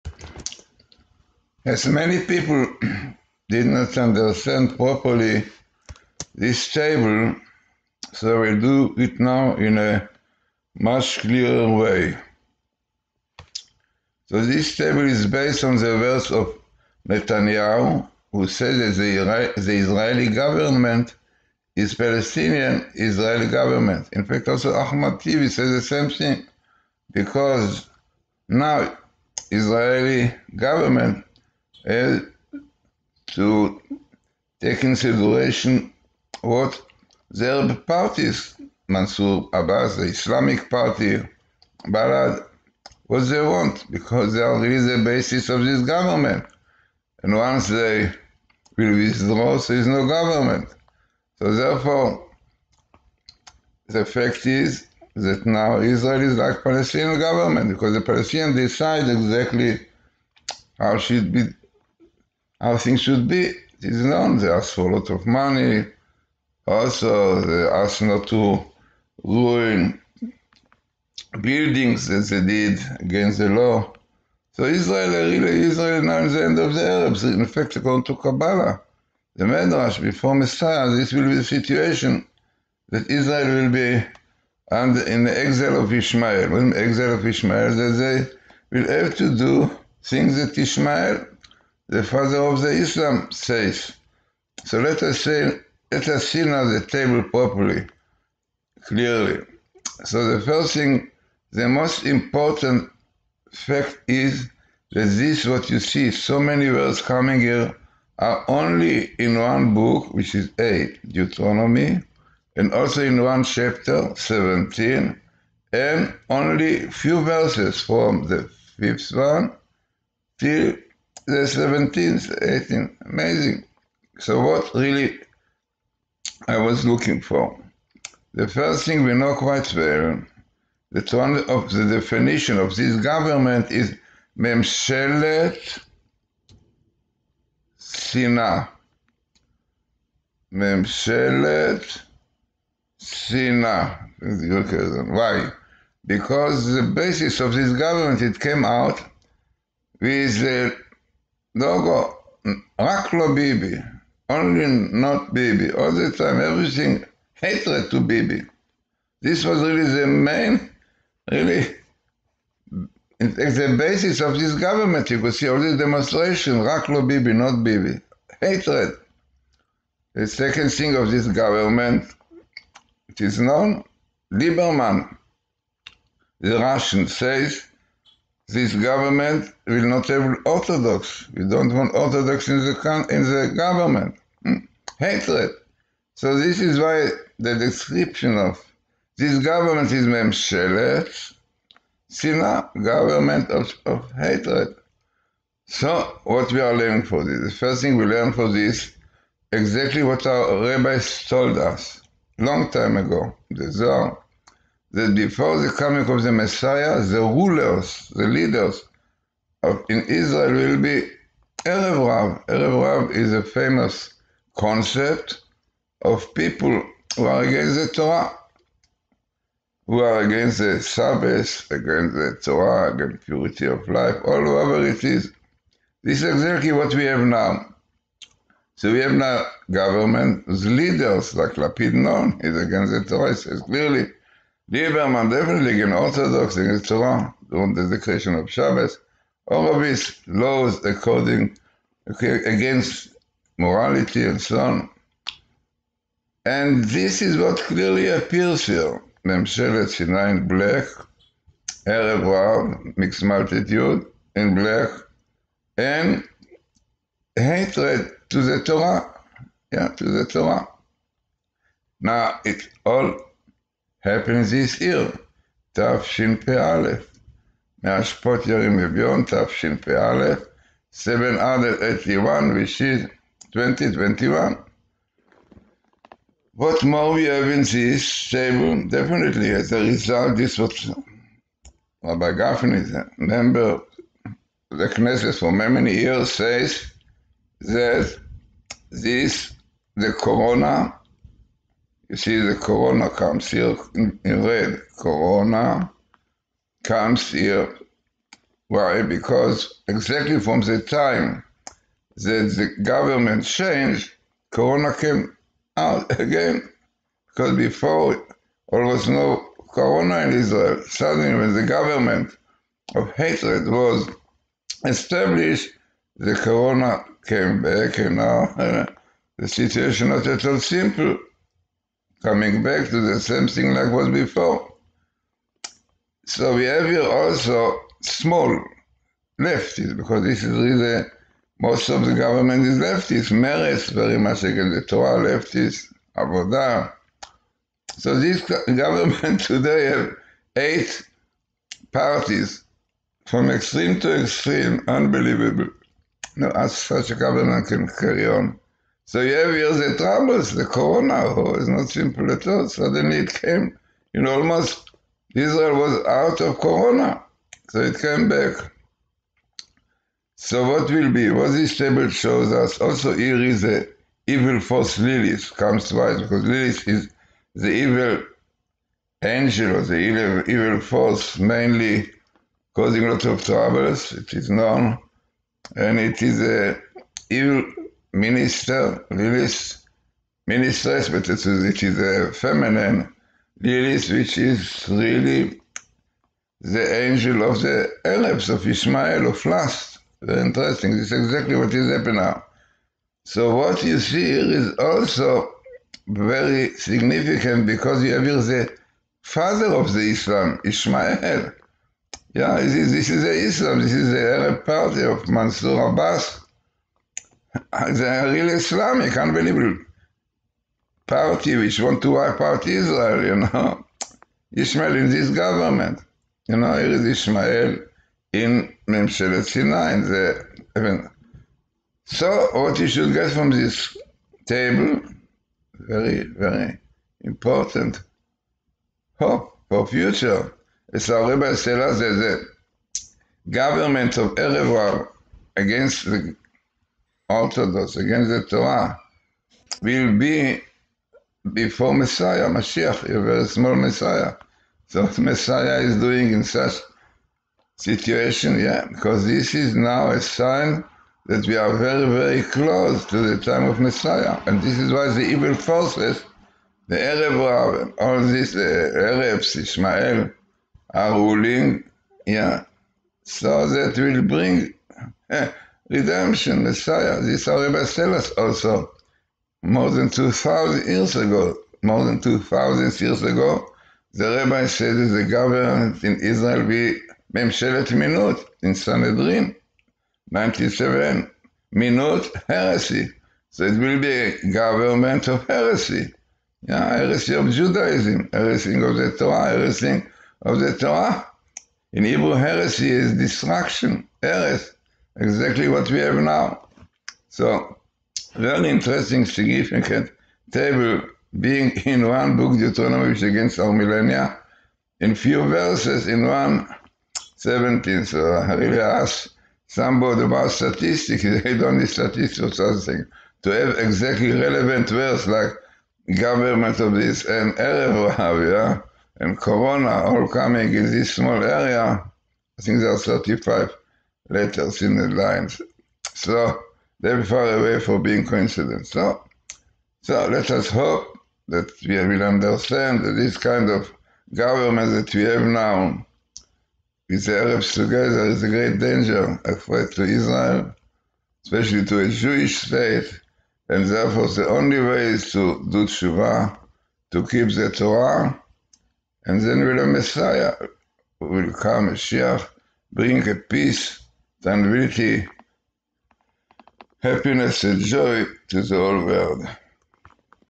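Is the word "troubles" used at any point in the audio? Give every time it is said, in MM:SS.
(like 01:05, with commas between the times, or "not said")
05:49, 06:13.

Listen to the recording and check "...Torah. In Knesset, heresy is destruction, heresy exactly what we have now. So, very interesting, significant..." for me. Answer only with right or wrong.
wrong.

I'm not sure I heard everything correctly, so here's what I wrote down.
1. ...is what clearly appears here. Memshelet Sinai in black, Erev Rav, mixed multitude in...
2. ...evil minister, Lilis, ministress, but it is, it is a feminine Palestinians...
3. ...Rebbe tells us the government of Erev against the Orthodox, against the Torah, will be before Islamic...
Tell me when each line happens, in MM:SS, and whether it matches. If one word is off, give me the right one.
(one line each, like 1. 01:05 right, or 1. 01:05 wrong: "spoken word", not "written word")
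1. 04:07 right
2. 06:17 wrong: "Lilis", not "Palestinians"
3. 07:11 wrong: "Messiah", not "Islamic".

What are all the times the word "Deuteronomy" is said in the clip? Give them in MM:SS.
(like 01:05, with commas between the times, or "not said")
01:51, 08:22.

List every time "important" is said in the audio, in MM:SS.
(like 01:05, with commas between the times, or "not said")
01:42, 07:07.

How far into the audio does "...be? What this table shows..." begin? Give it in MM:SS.
06:01.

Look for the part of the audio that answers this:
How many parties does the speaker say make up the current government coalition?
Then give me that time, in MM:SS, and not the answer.
05:40.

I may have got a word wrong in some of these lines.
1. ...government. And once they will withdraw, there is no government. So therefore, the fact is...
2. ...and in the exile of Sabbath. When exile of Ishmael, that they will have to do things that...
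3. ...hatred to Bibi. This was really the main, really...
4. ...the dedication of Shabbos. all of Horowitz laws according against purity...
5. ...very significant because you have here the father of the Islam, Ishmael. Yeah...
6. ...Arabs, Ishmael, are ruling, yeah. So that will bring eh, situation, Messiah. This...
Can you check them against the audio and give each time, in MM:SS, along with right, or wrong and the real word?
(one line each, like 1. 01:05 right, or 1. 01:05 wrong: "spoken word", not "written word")
1. 00:45 right
2. 01:24 wrong: "Ishmael", not "Sabbath"
3. 02:37 right
4. 03:57 wrong: "morality", not "purity"
5. 06:36 right
6. 07:39 wrong: "redemption", not "situation".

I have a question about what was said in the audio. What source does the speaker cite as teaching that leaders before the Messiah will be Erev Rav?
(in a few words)
the Zohar.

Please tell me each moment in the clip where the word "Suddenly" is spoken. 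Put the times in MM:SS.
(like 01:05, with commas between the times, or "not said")
05:10, 05:52.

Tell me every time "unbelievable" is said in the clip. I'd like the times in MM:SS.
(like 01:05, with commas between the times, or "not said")
05:44, 06:49.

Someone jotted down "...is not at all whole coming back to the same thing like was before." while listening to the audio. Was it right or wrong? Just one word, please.
wrong.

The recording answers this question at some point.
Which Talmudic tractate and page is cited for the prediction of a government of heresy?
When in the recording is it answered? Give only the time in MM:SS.
07:58.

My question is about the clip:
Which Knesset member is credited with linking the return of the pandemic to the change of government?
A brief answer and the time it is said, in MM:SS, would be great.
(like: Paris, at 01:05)
Rabbi Gafni, at 04:42.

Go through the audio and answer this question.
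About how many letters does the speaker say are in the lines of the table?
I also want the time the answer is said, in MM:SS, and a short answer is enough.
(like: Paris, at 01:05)
35, at 08:42.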